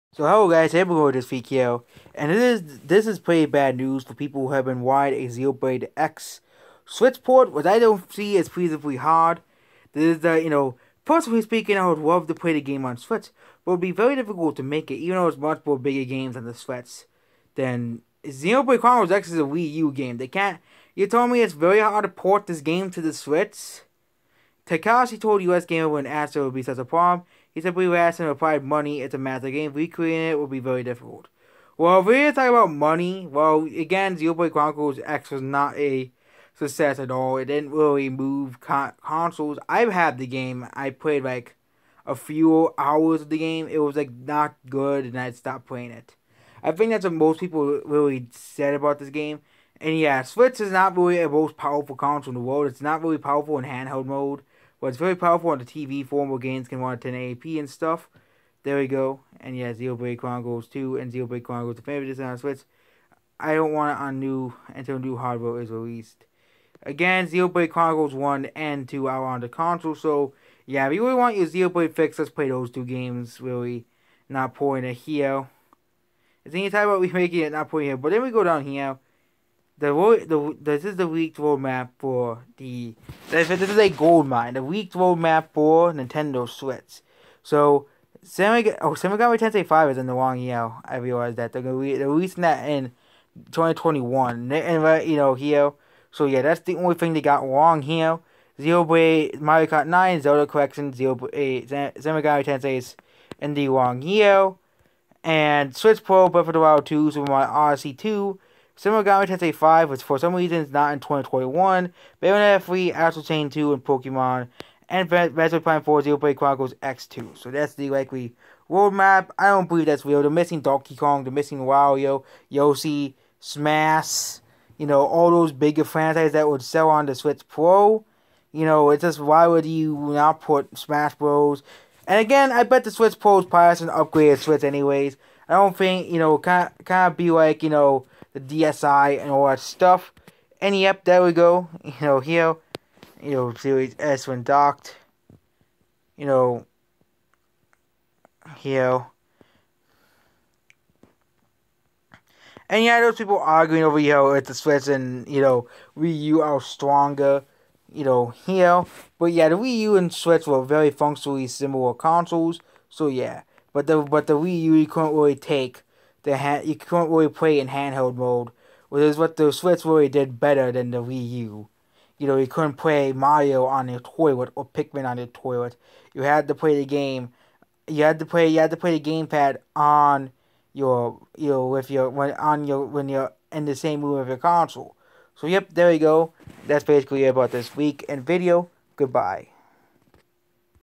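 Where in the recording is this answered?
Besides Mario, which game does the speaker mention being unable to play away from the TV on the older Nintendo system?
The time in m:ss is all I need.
2:54.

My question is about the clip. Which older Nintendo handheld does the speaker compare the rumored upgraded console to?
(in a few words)
DSi.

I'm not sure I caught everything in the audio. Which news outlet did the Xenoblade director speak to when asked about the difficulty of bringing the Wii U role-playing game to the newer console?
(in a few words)
USgamer.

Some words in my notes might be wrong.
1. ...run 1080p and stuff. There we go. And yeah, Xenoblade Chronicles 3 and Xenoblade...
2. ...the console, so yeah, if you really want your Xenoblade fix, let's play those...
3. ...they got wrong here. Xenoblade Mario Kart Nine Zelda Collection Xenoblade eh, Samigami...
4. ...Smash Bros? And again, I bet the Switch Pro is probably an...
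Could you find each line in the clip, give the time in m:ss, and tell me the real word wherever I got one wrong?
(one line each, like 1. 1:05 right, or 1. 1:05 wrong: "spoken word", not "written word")
1. 0:56 wrong: "2", not "3"
2. 1:09 right
3. 1:37 right
4. 2:10 right.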